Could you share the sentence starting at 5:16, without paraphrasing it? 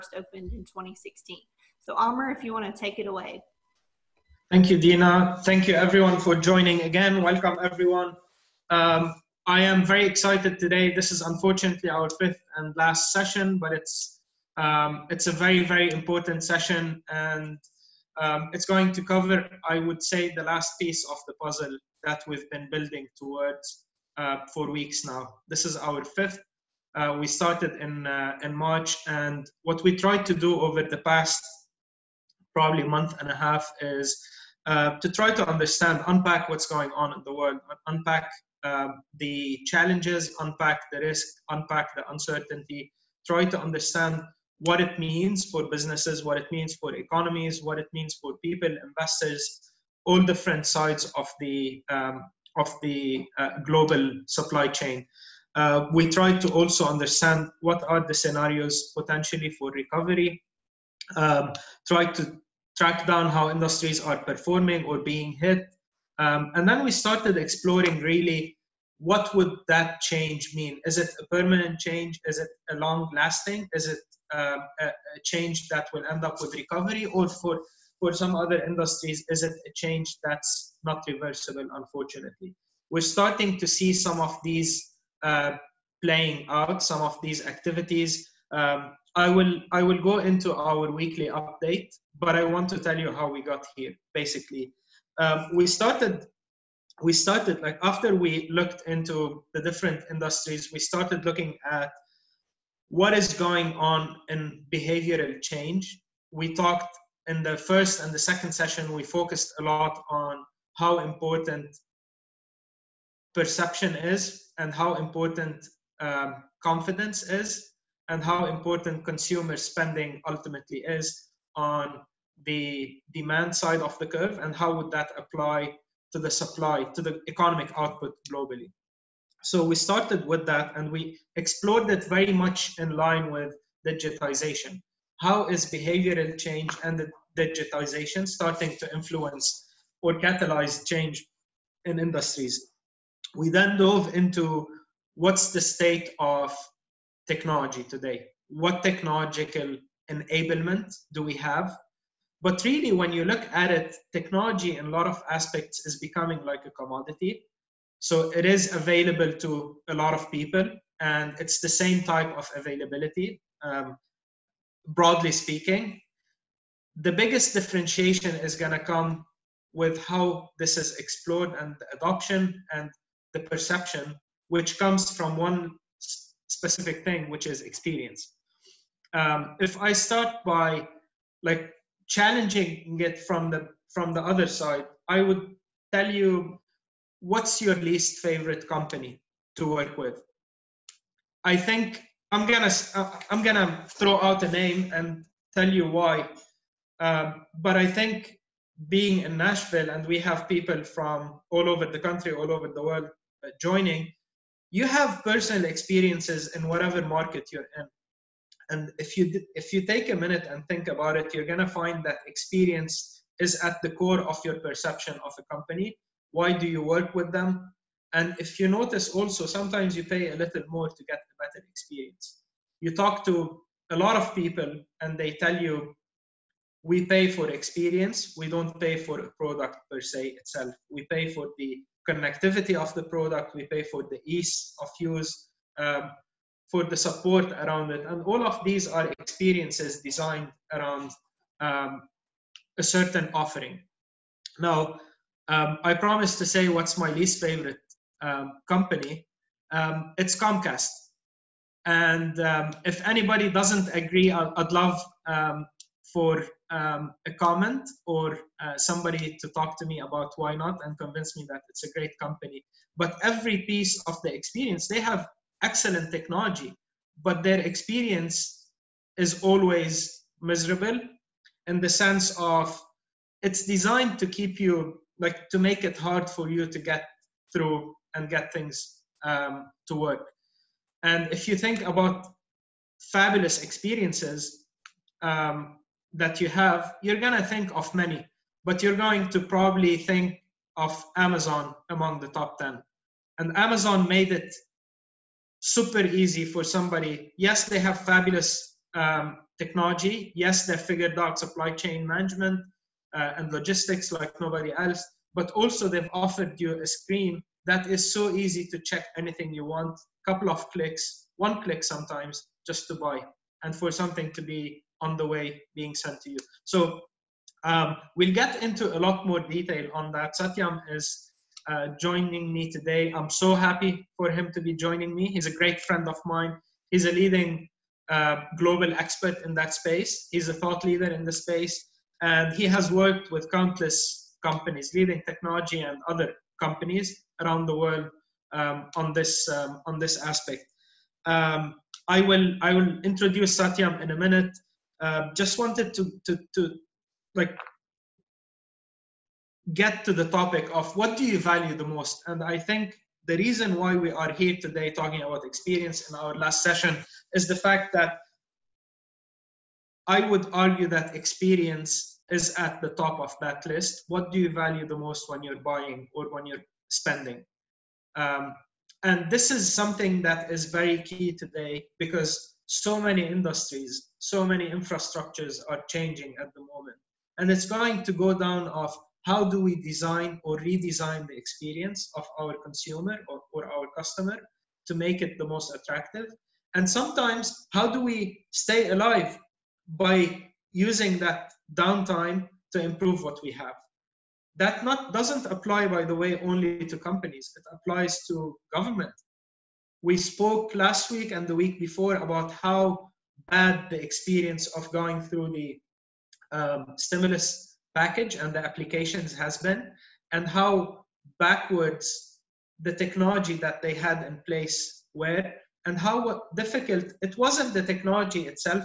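So um, we'll get into a lot more detail on that.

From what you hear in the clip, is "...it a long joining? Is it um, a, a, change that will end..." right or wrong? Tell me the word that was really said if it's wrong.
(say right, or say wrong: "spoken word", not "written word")
wrong: "lasting", not "joining".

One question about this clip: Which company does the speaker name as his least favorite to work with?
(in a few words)
Comcast.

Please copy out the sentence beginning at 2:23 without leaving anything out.
We then dove into what's the state of technology today?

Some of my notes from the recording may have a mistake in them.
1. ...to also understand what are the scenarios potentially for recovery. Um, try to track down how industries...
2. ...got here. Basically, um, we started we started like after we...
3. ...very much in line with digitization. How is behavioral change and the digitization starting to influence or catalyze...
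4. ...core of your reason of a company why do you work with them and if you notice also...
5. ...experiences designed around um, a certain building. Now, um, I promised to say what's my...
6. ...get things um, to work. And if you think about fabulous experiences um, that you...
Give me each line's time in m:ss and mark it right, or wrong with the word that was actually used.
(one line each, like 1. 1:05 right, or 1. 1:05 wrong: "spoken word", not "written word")
1. 0:56 right
2. 1:33 right
3. 2:12 right
4. 3:33 wrong: "perception", not "reason"
5. 3:59 wrong: "offering", not "building"
6. 4:38 right.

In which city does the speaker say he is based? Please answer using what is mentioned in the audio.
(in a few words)
Nashville.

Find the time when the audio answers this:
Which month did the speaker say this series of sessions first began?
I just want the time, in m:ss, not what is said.
0:28.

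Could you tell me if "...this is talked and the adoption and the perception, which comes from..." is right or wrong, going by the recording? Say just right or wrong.
wrong.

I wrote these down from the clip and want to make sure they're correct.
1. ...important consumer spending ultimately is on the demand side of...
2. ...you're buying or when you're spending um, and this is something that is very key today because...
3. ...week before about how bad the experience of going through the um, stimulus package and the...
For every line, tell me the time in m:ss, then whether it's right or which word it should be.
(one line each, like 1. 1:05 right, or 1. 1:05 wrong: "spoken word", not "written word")
1. 1:58 right
2. 6:05 right
3. 6:41 right.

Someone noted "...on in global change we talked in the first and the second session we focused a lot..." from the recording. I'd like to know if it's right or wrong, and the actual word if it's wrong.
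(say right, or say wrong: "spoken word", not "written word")
wrong: "behavioral", not "global".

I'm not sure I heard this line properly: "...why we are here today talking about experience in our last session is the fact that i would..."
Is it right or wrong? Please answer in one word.
right.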